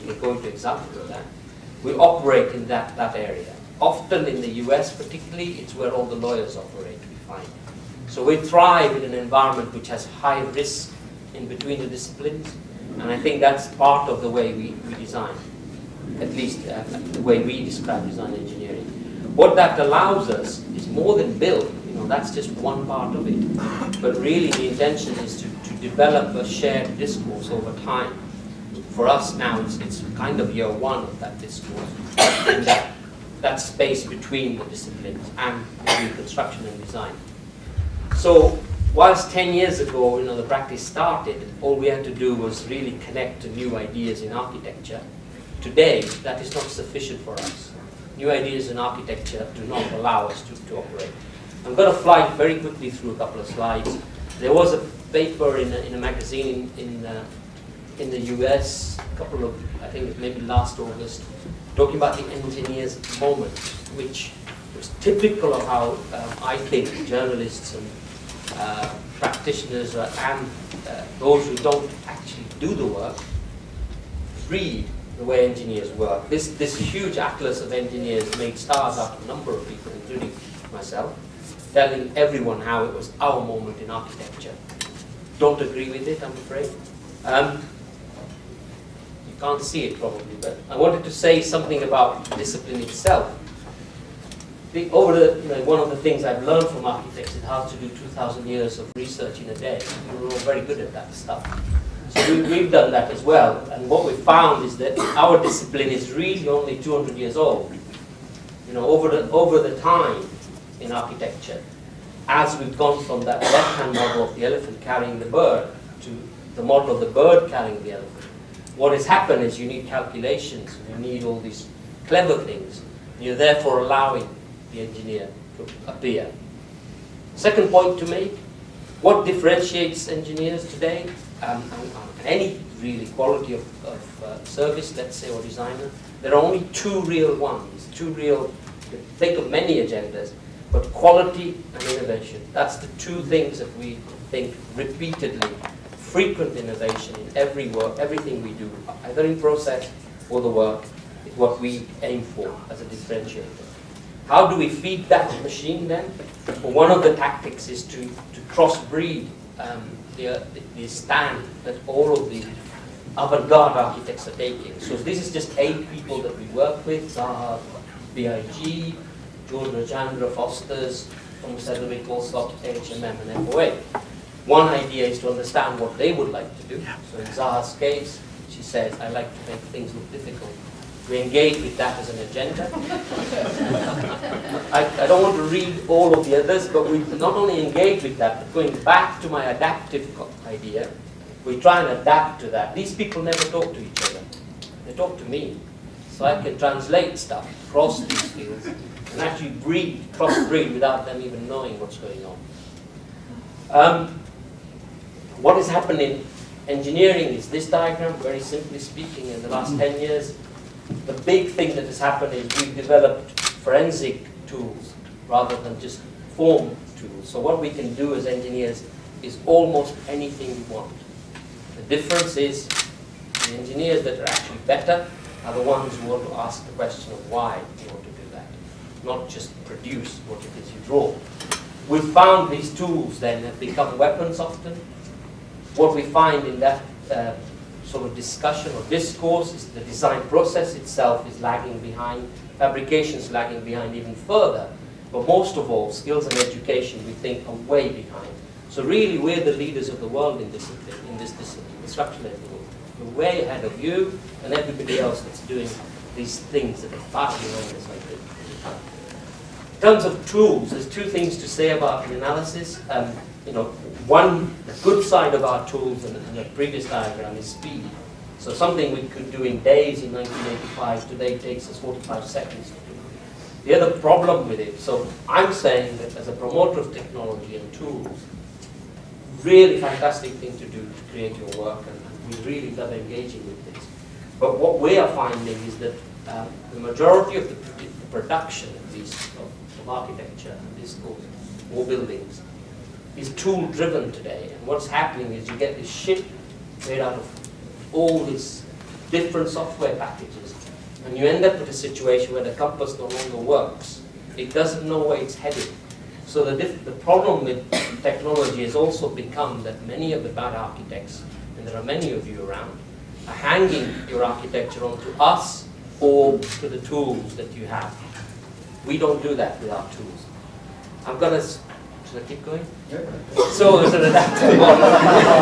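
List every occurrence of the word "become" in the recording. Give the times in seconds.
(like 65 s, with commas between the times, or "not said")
233 s, 309 s.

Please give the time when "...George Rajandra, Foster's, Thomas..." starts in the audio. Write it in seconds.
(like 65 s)
169 s.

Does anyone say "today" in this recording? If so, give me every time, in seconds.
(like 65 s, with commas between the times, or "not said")
45 s, 130 s, 271 s, 294 s.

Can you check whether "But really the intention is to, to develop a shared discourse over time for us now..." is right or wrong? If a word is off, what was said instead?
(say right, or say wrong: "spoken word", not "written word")
right.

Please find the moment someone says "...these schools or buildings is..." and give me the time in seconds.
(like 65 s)
290 s.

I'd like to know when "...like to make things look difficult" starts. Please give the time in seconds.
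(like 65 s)
179 s.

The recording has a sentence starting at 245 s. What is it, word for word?
But most of all, skills and education, we think, are way behind.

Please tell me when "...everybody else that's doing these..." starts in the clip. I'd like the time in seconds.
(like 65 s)
254 s.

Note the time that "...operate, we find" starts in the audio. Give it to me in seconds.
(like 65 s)
6 s.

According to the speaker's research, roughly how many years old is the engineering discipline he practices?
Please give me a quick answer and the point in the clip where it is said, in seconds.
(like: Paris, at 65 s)
200 years, at 106 s.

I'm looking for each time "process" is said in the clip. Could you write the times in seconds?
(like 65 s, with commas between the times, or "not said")
149 s, 240 s.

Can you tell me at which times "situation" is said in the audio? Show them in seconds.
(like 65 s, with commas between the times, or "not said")
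301 s.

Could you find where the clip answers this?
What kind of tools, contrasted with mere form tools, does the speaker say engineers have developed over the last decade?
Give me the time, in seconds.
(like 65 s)
213 s.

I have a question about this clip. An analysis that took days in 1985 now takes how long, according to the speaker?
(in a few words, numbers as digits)
45 seconds.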